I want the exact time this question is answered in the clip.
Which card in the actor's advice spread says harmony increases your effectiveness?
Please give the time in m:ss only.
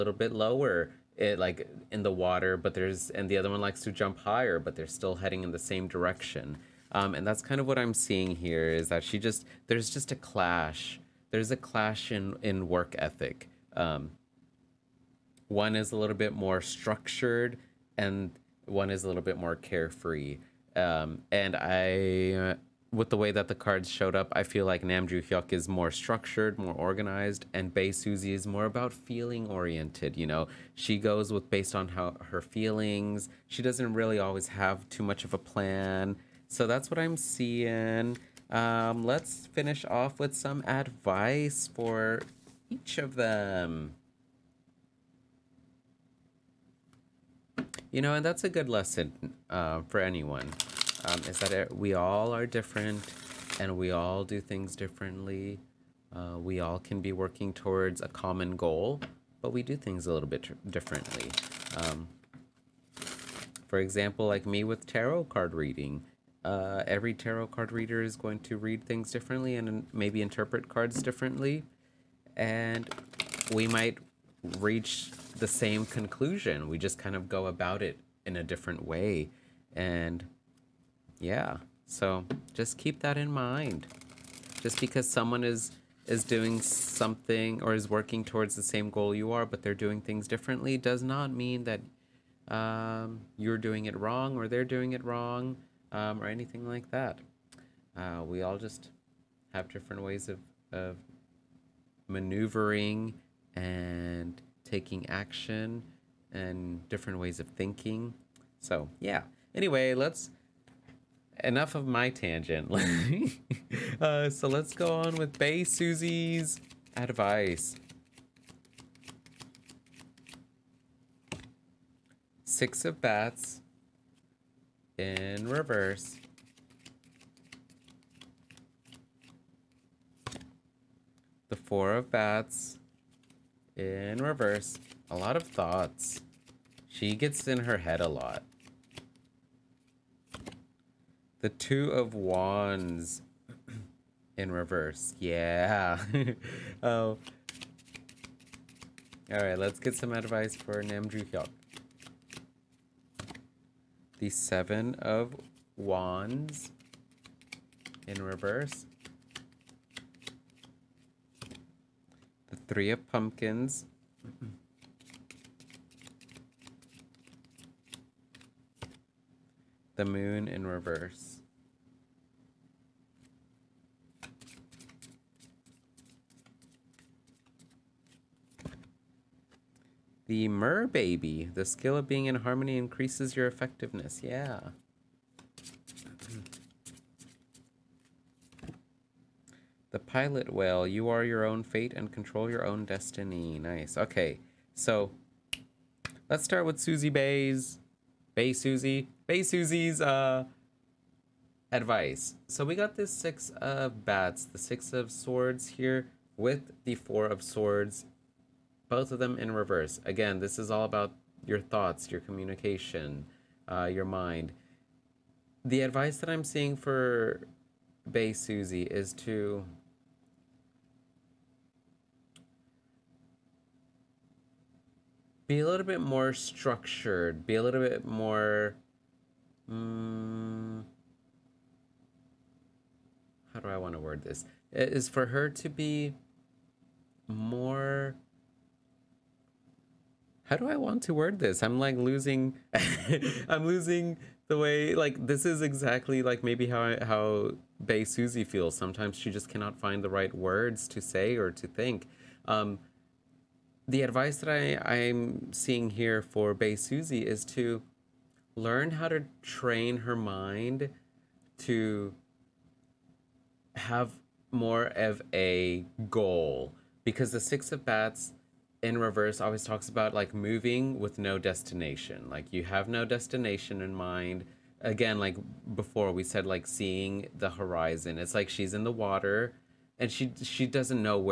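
3:00.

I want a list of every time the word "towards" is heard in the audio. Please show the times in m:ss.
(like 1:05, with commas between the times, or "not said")
0:57, 1:28.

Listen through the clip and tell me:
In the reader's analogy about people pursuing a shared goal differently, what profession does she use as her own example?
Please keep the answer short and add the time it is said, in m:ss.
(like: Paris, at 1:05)
tarot card reading, at 1:04.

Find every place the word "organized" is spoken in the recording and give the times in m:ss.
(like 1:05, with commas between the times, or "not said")
0:26.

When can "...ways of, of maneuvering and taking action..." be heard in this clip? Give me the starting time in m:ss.
1:40.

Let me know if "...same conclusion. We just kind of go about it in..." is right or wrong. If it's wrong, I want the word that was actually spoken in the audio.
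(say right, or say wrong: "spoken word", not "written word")
right.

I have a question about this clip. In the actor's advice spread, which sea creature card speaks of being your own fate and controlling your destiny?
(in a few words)
Pilot whale.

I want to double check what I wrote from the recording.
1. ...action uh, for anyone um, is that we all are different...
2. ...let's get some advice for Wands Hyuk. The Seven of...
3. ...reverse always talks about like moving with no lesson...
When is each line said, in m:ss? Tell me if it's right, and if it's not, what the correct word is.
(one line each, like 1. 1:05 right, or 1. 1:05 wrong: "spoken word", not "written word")
1. 0:48 wrong: "lesson", not "action"
2. 2:29 wrong: "Namju", not "Wands"
3. 4:28 wrong: "destination", not "lesson".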